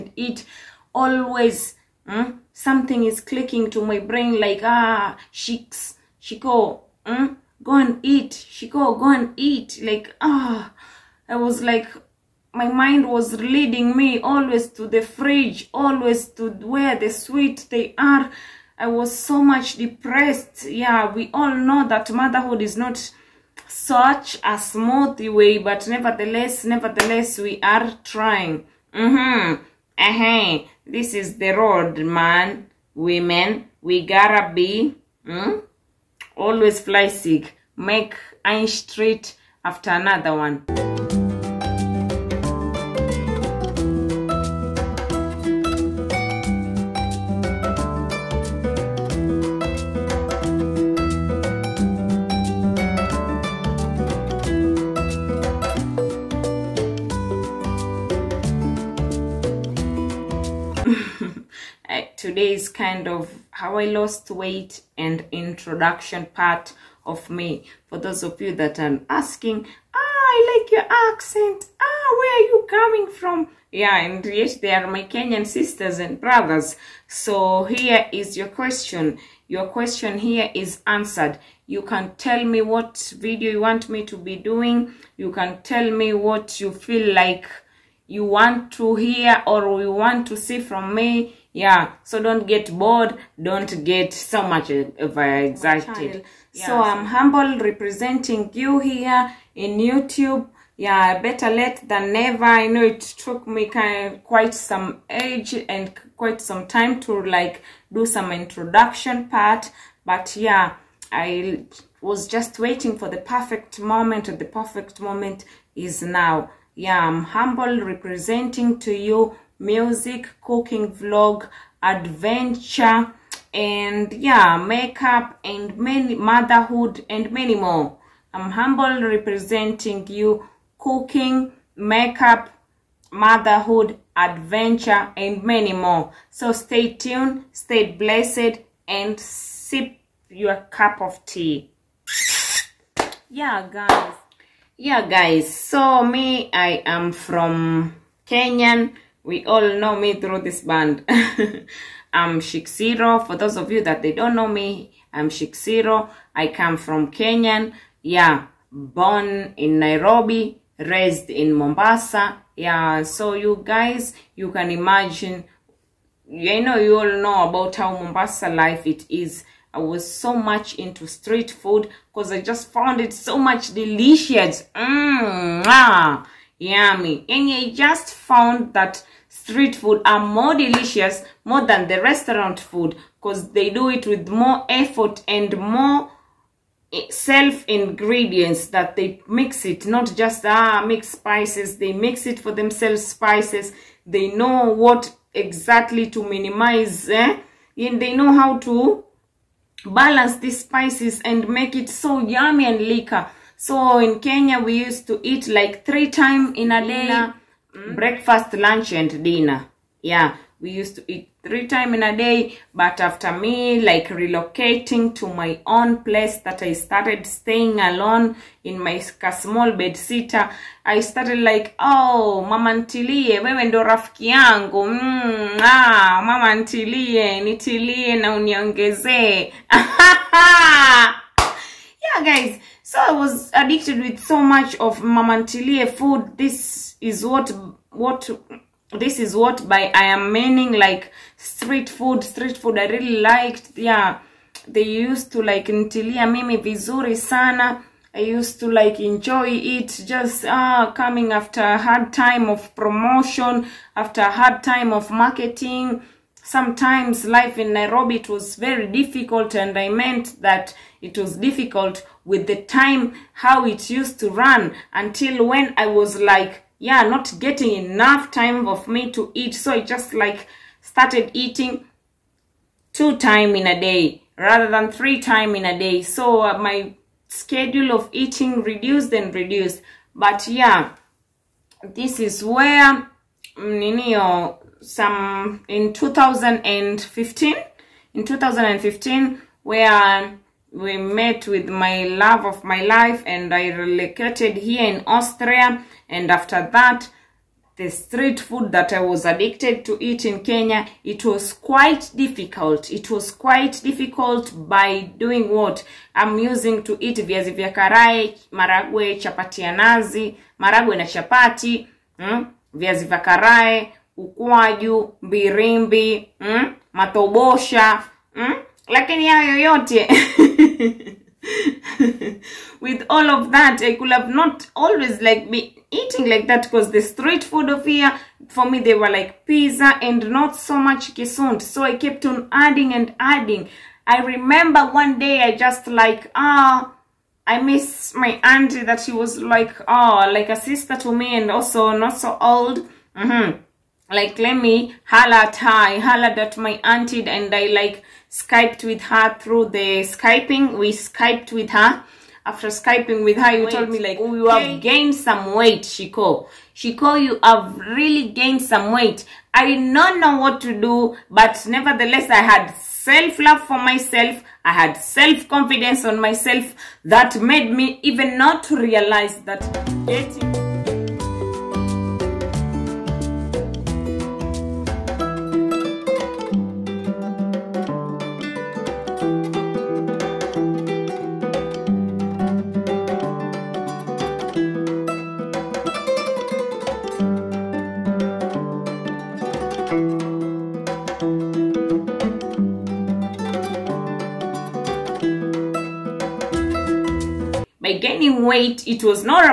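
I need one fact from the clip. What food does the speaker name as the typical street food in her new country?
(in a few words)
pizza.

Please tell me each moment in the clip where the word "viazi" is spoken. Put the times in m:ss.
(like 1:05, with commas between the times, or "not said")
5:07, 5:12.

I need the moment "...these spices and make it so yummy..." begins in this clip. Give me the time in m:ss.
3:20.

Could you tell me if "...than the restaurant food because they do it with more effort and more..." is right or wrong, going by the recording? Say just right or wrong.
right.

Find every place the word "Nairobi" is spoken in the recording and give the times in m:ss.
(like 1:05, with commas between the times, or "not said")
2:39, 4:17.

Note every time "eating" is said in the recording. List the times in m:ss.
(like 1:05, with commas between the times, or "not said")
4:31, 4:38, 5:25.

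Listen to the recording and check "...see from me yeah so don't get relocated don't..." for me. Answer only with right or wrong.
wrong.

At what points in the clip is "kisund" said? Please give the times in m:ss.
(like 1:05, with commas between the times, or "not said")
5:31.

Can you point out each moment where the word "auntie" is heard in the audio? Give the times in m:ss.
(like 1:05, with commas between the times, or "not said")
5:38, 5:46.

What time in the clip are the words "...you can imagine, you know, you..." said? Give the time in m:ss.
2:44.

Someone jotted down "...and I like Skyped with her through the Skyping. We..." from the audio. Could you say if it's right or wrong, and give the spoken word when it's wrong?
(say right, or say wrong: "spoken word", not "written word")
right.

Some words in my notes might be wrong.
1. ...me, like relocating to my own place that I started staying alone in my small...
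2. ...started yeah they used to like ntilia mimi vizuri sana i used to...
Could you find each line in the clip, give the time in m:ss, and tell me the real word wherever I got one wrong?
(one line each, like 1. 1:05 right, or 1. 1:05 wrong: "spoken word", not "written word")
1. 3:33 right
2. 4:03 wrong: "liked", not "started".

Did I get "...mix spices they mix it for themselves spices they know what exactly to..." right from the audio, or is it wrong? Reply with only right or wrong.
right.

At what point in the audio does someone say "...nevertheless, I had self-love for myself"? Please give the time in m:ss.
6:01.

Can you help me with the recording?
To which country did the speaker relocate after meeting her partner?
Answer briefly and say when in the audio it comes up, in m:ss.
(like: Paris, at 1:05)
Austria, at 4:53.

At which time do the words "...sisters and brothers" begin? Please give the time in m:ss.
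1:15.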